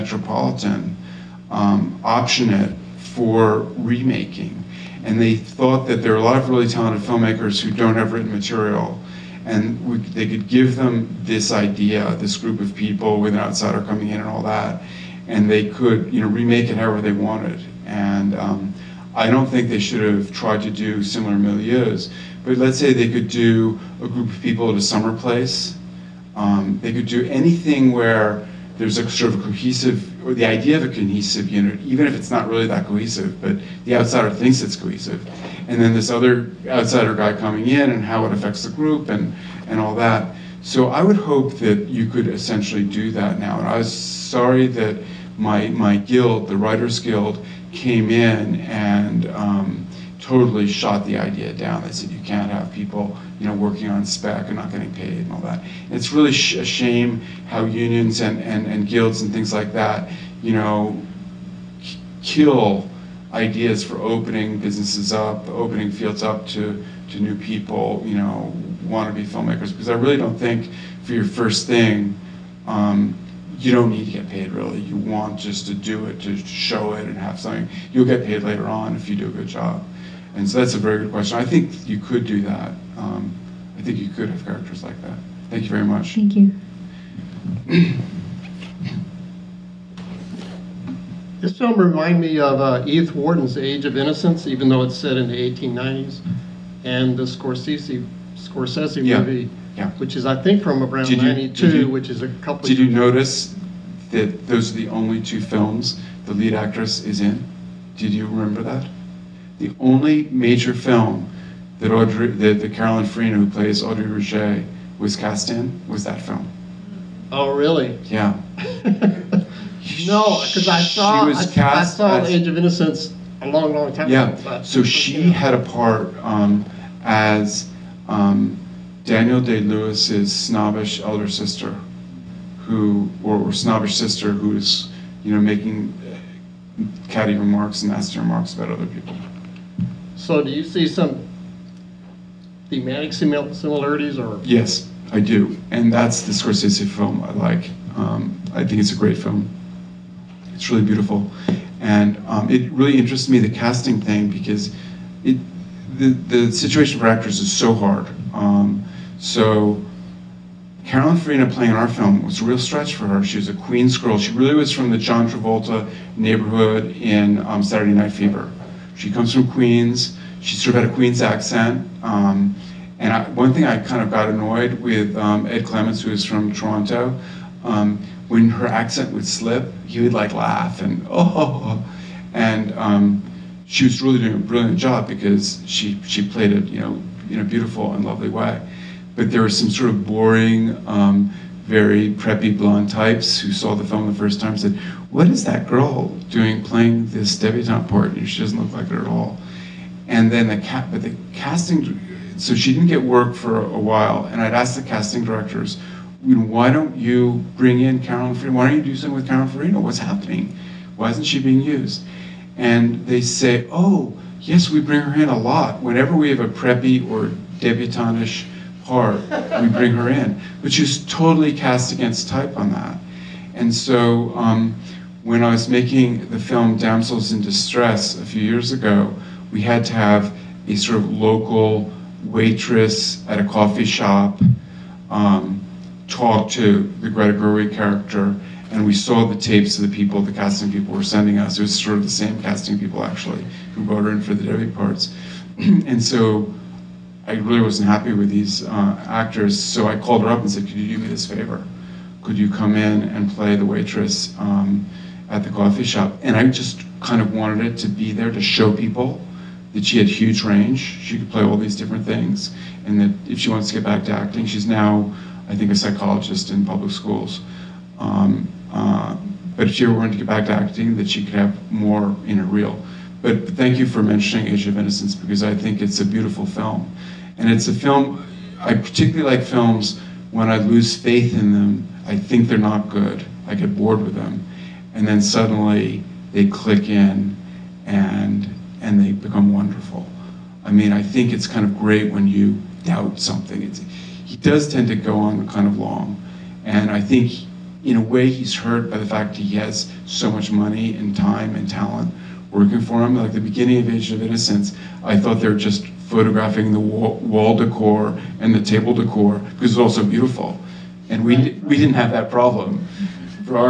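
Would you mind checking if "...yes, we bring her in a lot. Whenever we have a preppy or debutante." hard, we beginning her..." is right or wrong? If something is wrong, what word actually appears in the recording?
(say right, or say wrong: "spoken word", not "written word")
wrong: "bring", not "beginning".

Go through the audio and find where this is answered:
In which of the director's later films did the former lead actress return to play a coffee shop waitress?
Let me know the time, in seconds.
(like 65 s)
226 s.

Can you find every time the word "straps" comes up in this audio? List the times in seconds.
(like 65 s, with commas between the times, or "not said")
not said.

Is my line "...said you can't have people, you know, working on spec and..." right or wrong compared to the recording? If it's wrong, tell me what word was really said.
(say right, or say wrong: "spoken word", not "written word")
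right.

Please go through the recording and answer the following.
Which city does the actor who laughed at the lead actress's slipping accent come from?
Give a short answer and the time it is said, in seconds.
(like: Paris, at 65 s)
Toronto, at 176 s.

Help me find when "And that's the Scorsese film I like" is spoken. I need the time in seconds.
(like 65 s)
145 s.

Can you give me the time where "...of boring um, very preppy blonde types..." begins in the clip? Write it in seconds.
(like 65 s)
189 s.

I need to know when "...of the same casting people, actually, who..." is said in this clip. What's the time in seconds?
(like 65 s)
241 s.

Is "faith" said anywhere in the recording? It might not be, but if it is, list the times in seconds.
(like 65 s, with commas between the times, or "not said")
280 s.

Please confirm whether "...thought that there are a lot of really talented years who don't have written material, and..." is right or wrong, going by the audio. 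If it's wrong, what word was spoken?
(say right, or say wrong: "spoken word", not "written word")
wrong: "filmmakers", not "years".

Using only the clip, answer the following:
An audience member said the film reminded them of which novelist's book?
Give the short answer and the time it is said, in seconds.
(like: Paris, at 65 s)
Edith Wharton, at 92 s.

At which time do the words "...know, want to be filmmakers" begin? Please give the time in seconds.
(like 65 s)
68 s.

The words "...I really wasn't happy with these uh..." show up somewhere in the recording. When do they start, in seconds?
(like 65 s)
247 s.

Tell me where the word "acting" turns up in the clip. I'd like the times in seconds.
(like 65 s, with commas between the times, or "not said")
264 s, 270 s.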